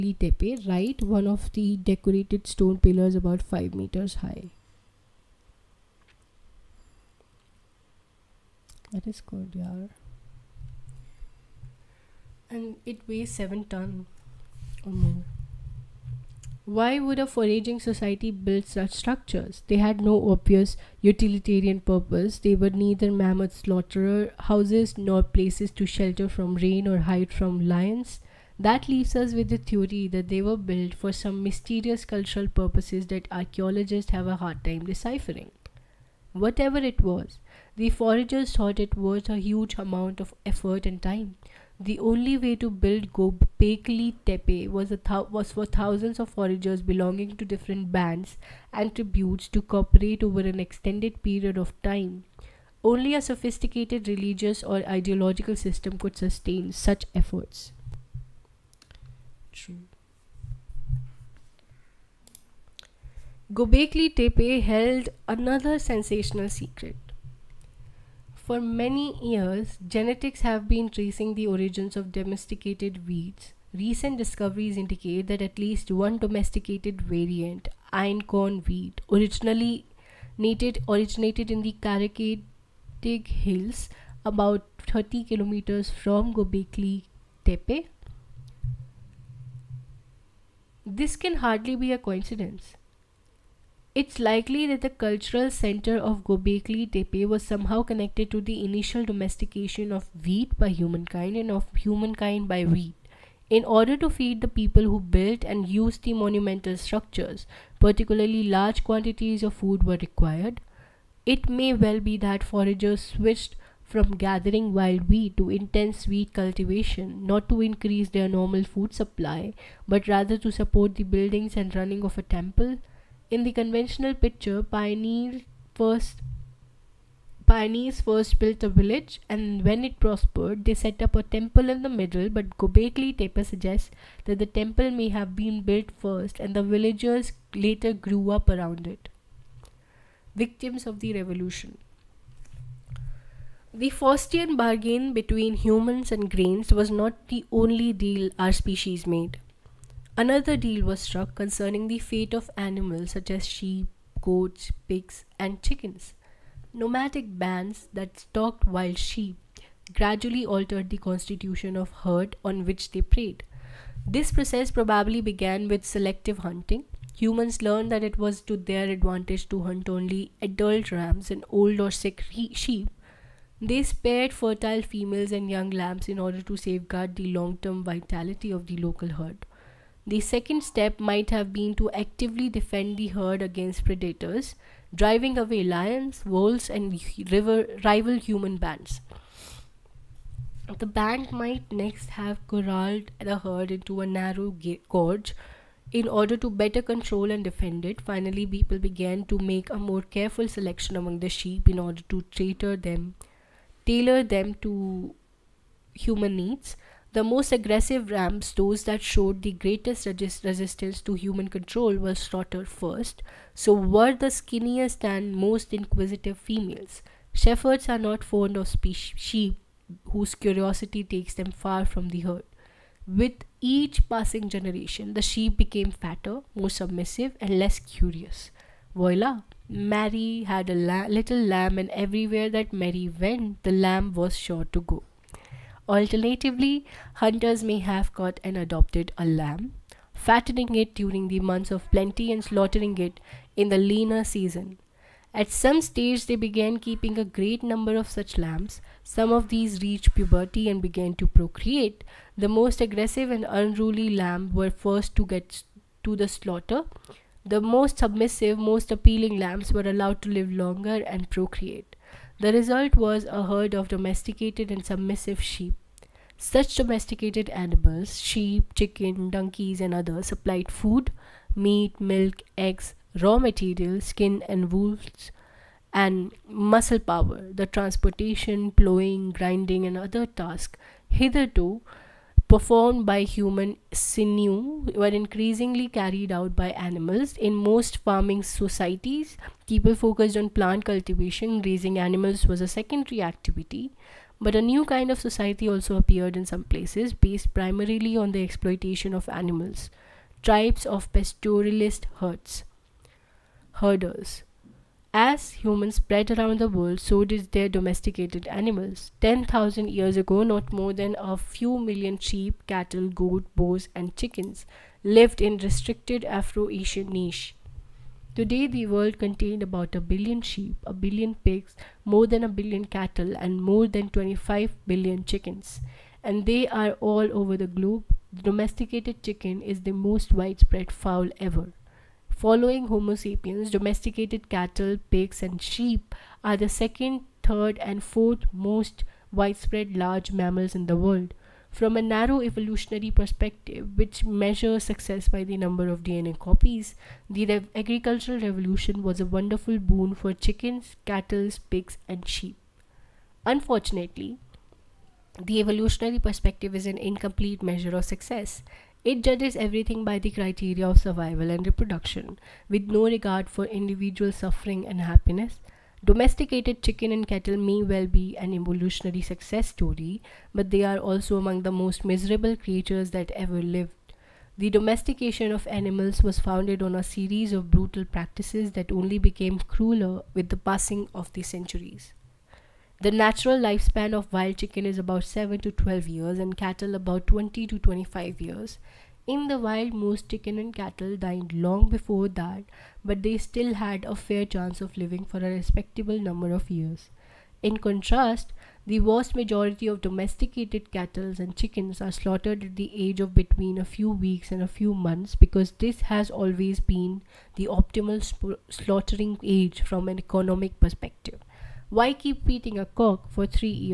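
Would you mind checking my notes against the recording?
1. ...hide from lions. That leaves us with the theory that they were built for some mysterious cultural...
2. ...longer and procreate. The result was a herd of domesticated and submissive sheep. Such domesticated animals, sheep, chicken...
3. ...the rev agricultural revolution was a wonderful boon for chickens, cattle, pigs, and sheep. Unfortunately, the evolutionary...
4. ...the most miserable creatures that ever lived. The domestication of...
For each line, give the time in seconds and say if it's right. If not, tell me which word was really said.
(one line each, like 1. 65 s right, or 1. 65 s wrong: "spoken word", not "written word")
1. 26 s right
2. 260 s right
3. 347 s right
4. 371 s right.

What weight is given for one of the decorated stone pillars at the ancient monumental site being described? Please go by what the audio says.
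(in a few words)
7 tons.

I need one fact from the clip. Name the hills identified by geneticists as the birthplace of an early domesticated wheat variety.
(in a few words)
Karacadag Hills.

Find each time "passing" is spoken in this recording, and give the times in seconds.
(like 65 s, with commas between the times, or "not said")
224 s, 380 s.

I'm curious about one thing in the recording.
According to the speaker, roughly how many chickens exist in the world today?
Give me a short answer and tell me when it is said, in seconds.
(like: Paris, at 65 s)
more than 25 billion, at 323 s.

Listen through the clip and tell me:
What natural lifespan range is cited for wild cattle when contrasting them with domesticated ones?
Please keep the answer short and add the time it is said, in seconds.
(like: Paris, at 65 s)
20 to 25 years, at 387 s.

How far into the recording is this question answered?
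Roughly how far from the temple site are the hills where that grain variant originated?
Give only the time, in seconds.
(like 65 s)
84 s.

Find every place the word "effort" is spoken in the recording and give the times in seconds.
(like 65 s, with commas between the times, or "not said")
40 s, 57 s.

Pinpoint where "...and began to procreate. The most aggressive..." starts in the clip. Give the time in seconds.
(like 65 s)
250 s.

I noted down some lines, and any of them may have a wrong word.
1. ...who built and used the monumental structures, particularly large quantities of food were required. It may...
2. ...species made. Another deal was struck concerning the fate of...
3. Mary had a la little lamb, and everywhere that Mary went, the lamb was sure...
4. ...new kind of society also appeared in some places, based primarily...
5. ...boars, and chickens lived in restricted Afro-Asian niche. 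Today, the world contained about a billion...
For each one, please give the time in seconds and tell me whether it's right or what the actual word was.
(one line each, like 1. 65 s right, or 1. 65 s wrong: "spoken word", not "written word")
1. 104 s right
2. 148 s right
3. 229 s right
4. 294 s right
5. 313 s right.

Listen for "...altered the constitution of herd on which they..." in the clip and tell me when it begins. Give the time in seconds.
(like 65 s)
160 s.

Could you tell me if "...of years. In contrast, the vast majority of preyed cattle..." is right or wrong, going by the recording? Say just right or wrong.
wrong.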